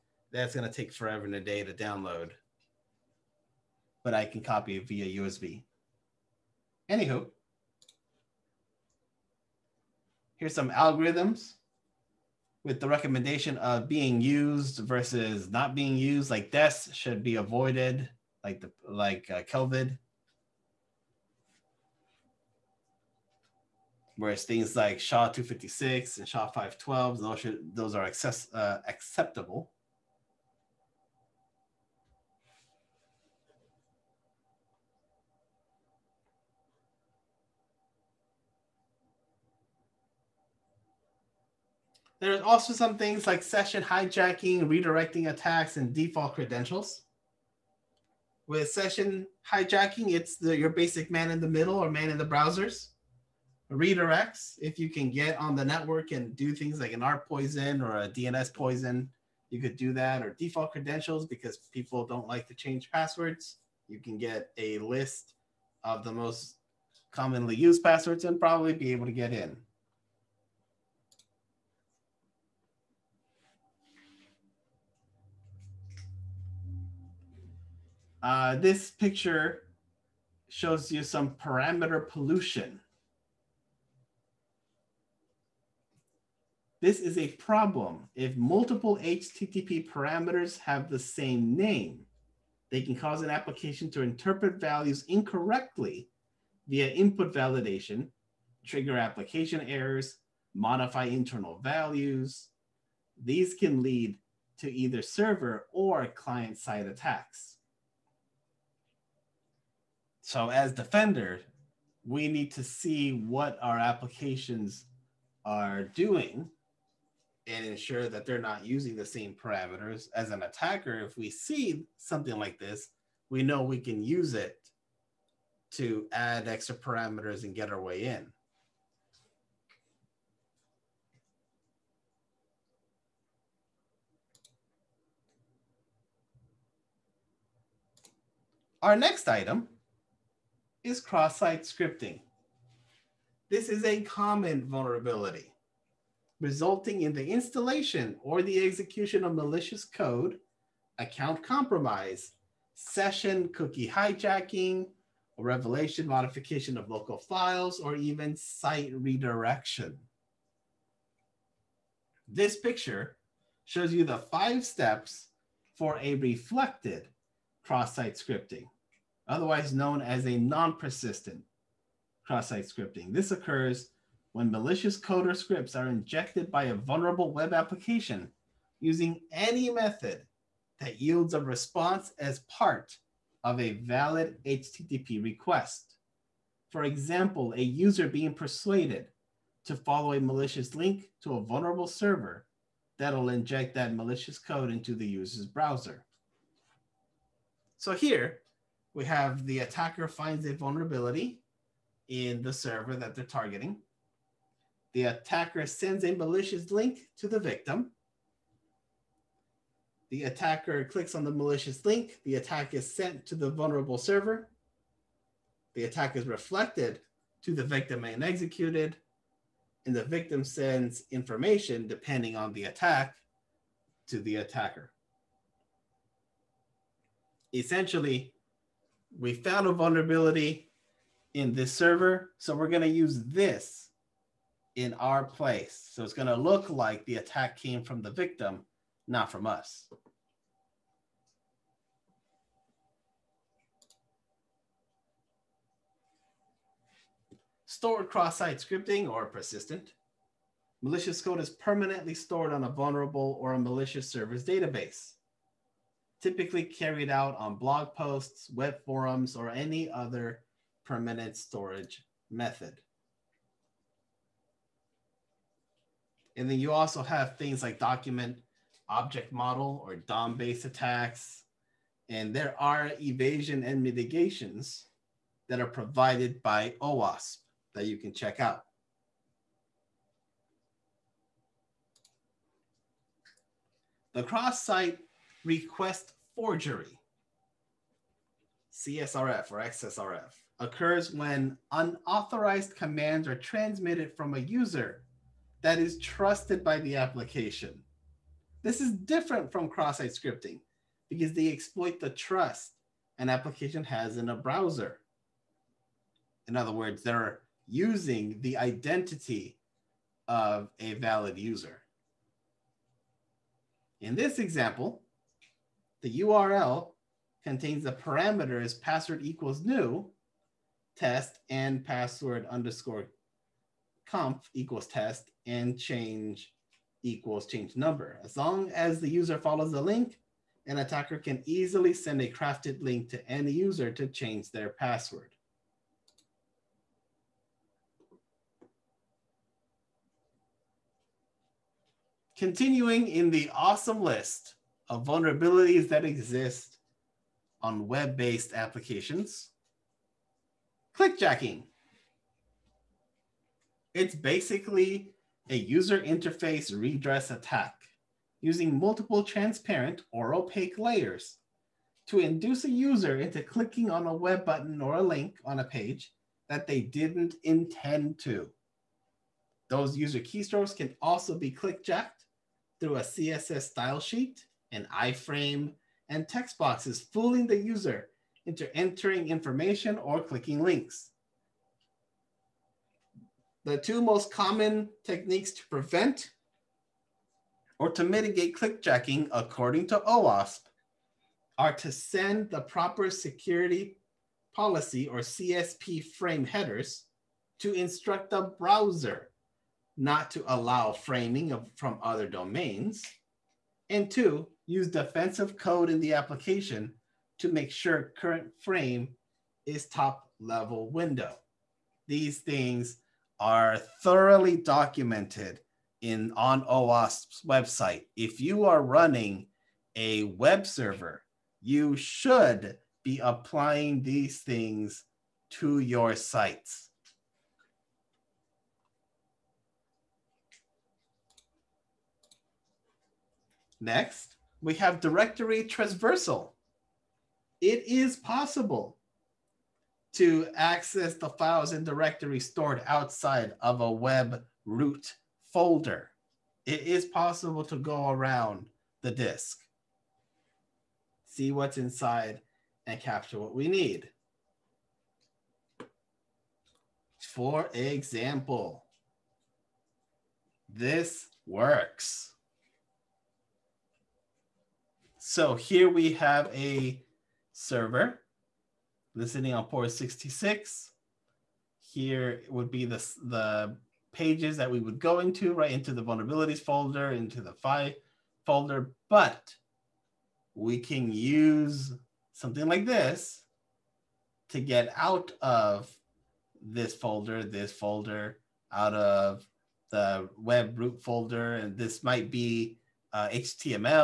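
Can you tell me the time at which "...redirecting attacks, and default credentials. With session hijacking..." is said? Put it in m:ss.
0:44.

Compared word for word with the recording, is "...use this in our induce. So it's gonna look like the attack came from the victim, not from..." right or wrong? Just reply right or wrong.
wrong.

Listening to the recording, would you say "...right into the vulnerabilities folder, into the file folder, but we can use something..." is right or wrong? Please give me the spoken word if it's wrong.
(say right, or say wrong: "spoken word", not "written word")
right.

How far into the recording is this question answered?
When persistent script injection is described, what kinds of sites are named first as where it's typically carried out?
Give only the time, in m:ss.
4:17.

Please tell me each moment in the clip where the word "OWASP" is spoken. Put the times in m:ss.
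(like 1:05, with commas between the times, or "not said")
4:36, 6:30, 6:56.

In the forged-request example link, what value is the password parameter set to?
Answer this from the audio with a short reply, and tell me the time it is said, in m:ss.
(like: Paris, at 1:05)
new test, at 5:19.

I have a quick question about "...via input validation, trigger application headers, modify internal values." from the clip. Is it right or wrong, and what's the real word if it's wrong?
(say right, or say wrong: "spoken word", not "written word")
wrong: "errors", not "headers".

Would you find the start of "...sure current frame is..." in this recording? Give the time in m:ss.
6:47.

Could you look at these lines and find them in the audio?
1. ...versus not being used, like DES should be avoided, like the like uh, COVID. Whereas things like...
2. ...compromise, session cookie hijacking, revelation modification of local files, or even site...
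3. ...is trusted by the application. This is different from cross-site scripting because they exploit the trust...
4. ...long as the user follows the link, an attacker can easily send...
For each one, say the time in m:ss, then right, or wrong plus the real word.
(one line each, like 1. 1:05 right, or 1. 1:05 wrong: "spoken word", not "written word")
1. 0:14 right
2. 2:31 right
3. 4:55 right
4. 5:28 right.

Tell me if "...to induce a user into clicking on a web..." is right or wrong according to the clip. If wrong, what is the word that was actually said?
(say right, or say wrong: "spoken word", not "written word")
right.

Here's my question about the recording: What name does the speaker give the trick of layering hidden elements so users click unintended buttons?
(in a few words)
user interface redress attack.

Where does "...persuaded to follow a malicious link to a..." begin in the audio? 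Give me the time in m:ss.
3:08.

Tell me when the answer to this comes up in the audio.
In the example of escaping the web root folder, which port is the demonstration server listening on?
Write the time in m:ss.
7:49.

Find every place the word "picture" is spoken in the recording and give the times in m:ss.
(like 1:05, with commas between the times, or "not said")
1:18, 2:42.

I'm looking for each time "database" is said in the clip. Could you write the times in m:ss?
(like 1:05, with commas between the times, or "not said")
4:14.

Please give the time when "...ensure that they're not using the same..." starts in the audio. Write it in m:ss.
1:57.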